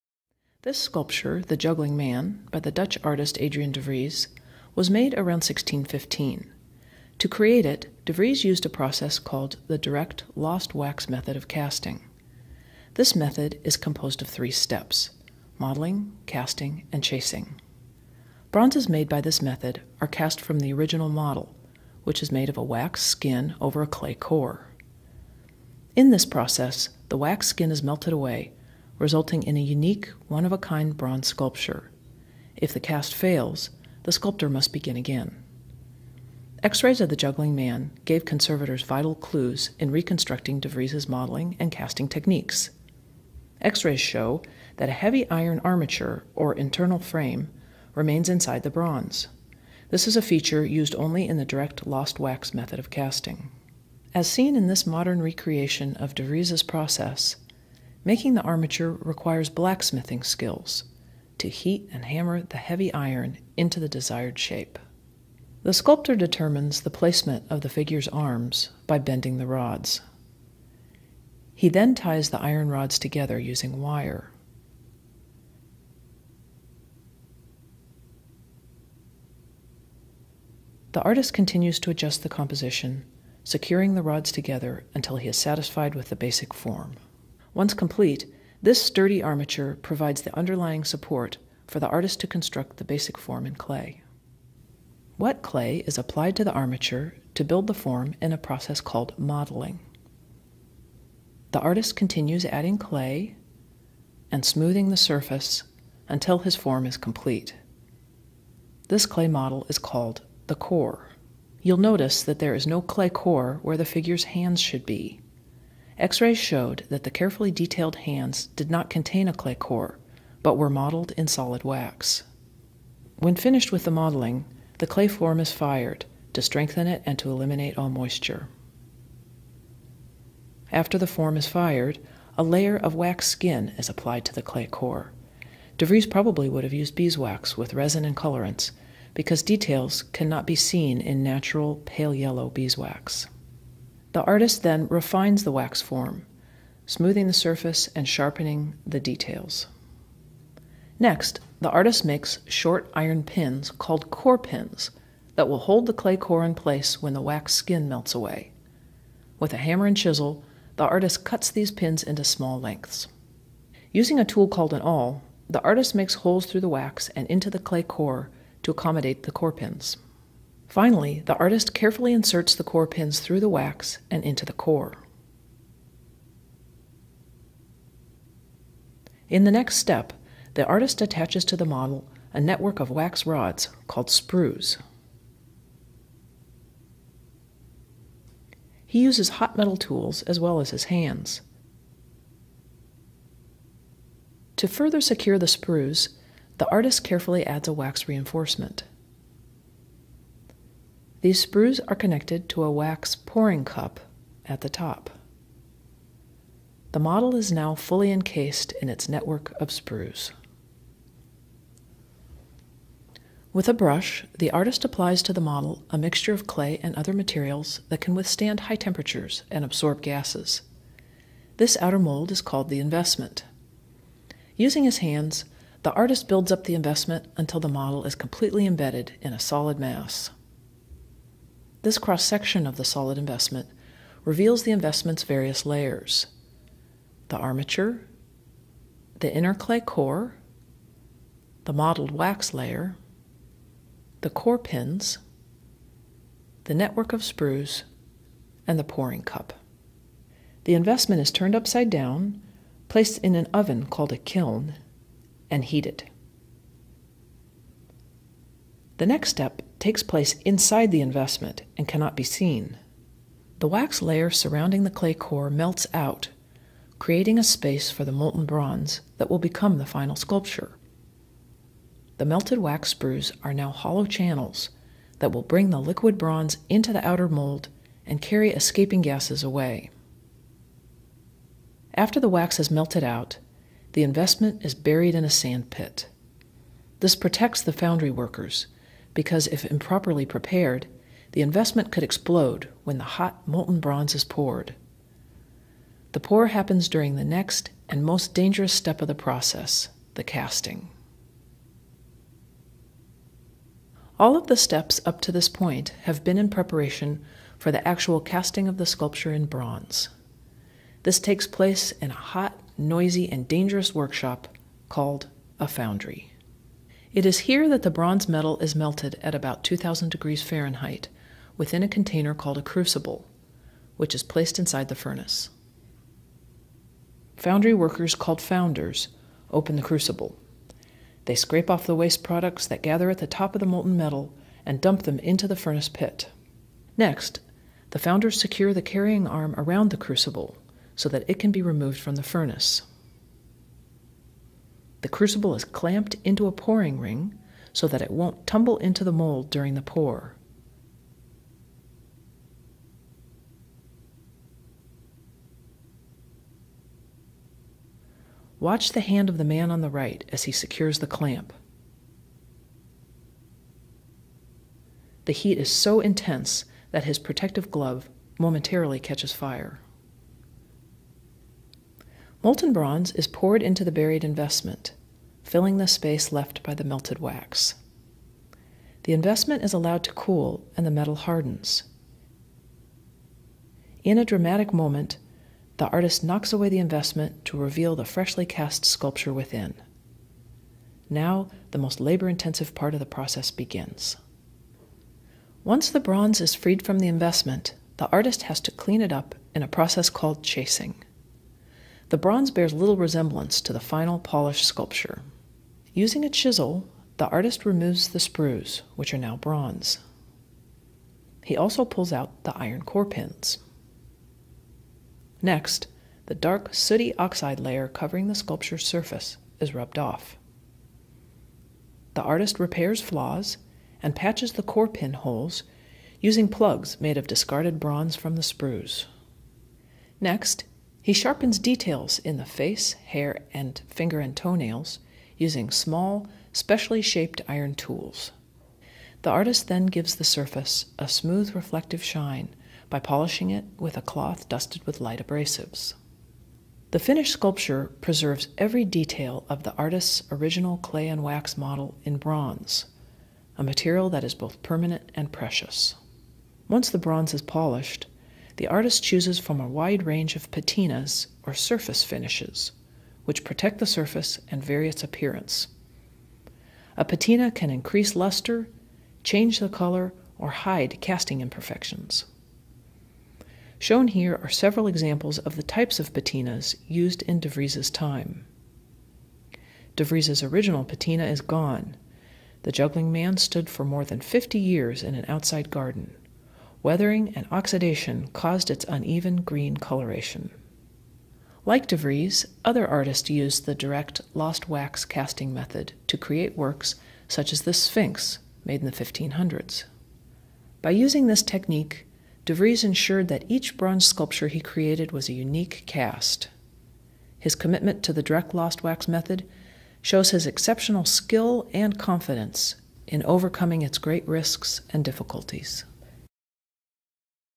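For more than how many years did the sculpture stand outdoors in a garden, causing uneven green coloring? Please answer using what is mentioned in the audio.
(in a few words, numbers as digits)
50 years.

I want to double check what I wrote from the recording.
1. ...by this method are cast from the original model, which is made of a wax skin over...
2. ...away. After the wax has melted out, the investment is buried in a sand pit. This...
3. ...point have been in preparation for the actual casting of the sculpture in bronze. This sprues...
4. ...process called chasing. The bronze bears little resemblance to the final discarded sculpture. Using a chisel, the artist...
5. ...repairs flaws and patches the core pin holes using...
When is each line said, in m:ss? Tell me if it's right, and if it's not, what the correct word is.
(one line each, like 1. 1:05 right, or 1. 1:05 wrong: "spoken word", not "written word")
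1. 0:19 right
2. 4:39 right
3. 5:05 wrong: "takes", not "sprues"
4. 6:39 wrong: "polished", not "discarded"
5. 7:02 right.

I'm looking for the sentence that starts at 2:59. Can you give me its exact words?
In the next step, the artist attaches to the model a network of wax rods called sprues.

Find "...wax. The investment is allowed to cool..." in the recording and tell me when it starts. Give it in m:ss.
6:17.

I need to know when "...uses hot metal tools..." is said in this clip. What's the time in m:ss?
3:08.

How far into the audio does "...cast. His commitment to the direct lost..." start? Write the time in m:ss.
8:25.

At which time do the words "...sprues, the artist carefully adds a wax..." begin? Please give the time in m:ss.
3:15.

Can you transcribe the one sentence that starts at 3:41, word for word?
This outer mold is called the investment.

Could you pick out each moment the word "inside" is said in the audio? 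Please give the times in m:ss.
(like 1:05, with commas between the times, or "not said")
0:48, 4:20, 5:24.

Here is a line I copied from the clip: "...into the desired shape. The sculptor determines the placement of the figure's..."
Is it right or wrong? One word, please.
right.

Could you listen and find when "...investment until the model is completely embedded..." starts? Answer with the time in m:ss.
3:46.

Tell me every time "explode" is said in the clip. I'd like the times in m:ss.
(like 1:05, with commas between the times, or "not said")
4:52.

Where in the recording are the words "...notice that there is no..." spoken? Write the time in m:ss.
1:51.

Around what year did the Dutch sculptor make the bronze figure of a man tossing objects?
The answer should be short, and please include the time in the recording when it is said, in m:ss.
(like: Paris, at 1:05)
1615, at 0:05.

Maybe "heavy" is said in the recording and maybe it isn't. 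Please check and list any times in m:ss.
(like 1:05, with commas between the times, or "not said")
0:45, 1:02.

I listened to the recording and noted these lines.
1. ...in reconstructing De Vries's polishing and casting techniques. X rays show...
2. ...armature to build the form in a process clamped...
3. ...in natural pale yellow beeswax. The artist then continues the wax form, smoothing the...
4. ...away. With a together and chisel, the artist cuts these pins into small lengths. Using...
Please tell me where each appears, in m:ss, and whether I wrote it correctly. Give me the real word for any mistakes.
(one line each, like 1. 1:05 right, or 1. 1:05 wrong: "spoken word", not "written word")
1. 0:39 wrong: "modeling", not "polishing"
2. 1:36 wrong: "called", not "clamped"
3. 2:20 wrong: "refines", not "continues"
4. 2:38 wrong: "hammer", not "together".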